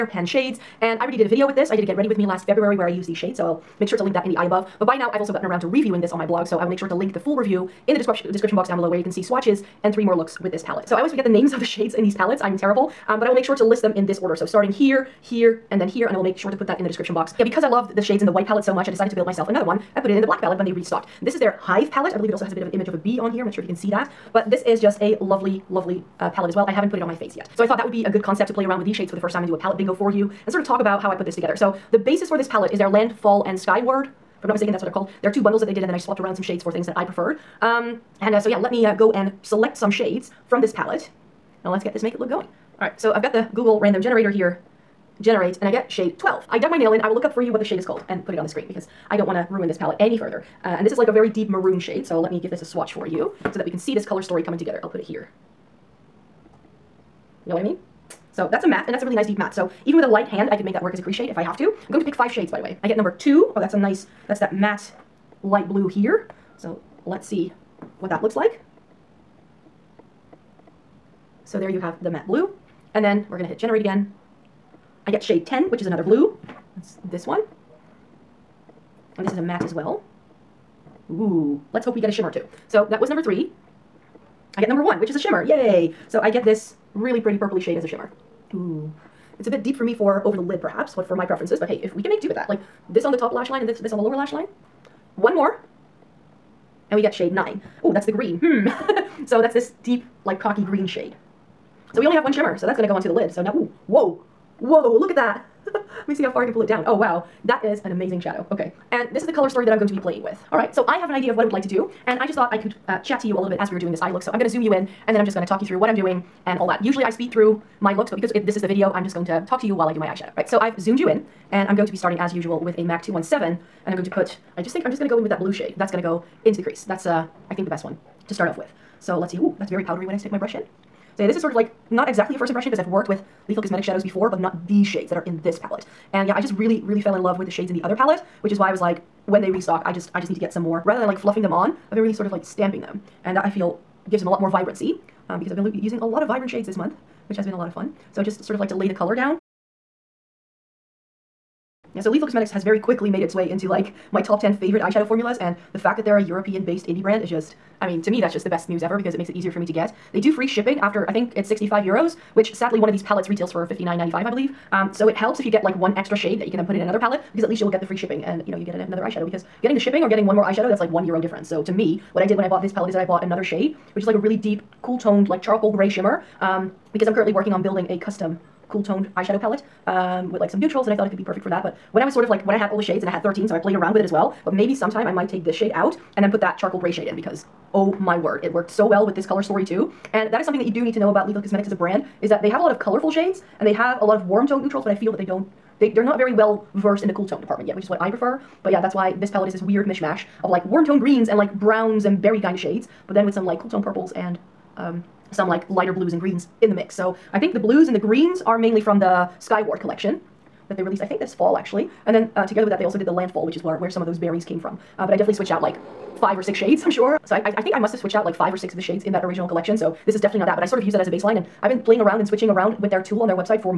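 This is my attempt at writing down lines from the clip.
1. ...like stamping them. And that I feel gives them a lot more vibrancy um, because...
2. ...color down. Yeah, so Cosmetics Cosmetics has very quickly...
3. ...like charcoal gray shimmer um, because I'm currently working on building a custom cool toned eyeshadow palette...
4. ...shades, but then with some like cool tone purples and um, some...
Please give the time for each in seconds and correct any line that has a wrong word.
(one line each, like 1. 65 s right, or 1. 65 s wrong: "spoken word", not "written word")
1. 142 s right
2. 148 s wrong: "Lethal", not "Cosmetics"
3. 175 s right
4. 202 s right.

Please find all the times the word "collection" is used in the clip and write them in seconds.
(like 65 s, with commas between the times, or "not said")
209 s, 219 s.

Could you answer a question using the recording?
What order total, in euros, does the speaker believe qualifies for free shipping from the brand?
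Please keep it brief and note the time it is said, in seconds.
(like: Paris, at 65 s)
65 euros, at 161 s.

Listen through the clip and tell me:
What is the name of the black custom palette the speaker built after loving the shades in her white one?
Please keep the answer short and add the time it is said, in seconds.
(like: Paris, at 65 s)
Hyve palette, at 21 s.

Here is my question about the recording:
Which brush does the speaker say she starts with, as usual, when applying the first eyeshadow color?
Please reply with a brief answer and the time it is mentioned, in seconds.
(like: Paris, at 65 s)
MAC 217, at 122 s.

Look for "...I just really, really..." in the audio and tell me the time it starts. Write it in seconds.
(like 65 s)
136 s.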